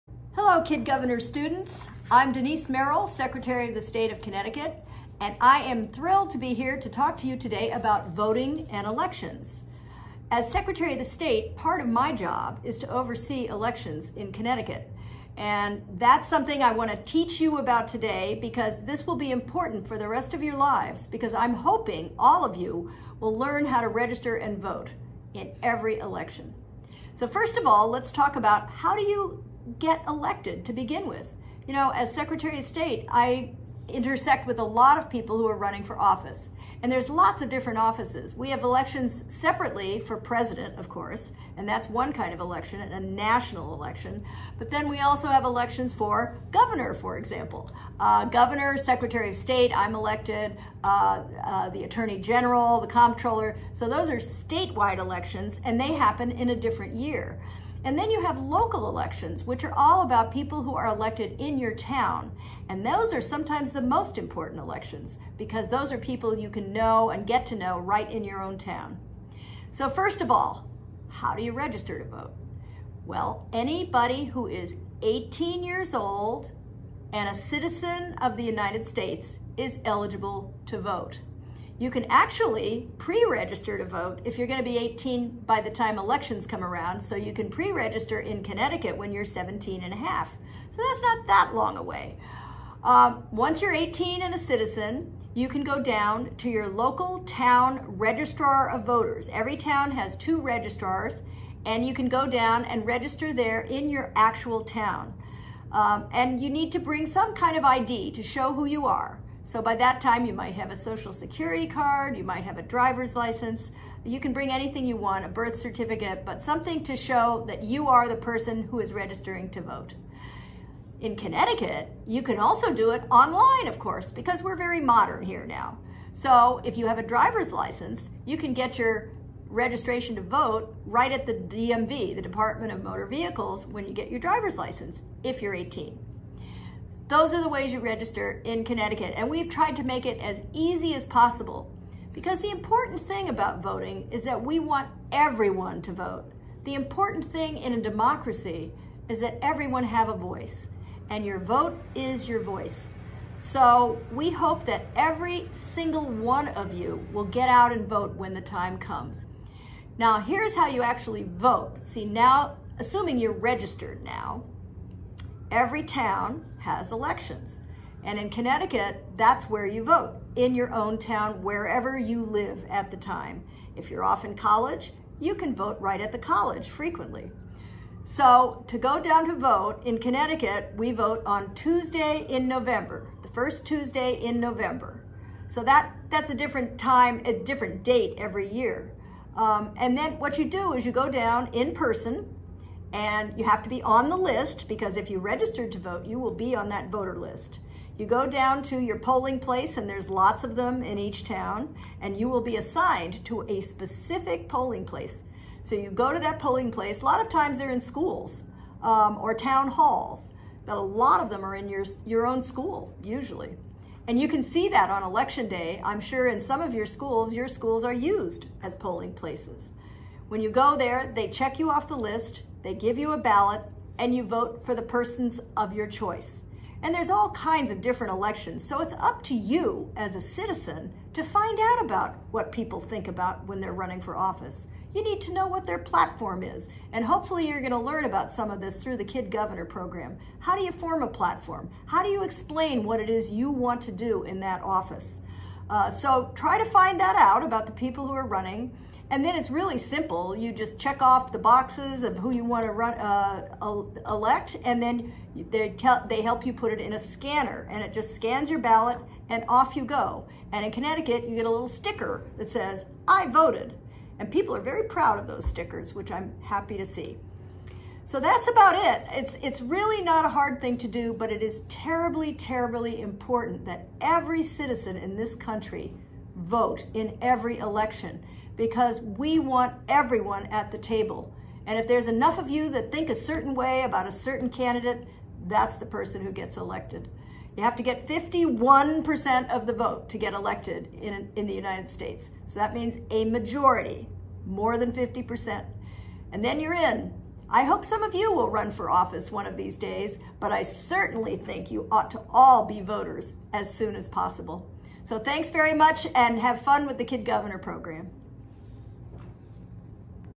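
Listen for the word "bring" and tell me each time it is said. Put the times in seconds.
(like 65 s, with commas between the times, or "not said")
106 s, 114 s.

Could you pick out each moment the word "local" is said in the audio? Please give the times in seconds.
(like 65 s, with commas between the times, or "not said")
58 s, 96 s.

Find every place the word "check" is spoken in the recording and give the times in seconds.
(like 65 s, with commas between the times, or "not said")
221 s, 250 s.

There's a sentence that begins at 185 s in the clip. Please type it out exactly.
So that, that's a different time, a different date every year.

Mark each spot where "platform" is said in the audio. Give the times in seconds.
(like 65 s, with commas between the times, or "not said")
235 s, 241 s.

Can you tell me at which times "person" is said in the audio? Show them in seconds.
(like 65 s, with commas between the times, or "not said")
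118 s, 191 s, 224 s, 285 s.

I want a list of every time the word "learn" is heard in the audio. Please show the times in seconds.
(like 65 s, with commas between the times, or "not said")
23 s, 237 s.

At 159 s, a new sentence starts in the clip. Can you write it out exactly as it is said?
Now, here's how you actually vote.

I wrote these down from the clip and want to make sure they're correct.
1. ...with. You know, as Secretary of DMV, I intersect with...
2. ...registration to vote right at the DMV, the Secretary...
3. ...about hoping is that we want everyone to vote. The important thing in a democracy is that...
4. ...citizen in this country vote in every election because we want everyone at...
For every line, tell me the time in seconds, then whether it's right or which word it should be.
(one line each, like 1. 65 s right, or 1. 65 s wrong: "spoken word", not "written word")
1. 31 s wrong: "State", not "DMV"
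2. 129 s wrong: "Department", not "Secretary"
3. 143 s wrong: "voting", not "hoping"
4. 274 s right.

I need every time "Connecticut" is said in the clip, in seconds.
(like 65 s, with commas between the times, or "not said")
4 s, 14 s, 88 s, 121 s, 138 s, 168 s, 179 s, 260 s.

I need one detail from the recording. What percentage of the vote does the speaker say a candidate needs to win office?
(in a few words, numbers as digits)
51%.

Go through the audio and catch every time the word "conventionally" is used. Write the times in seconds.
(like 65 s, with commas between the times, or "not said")
not said.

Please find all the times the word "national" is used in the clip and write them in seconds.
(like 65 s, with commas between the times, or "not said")
42 s.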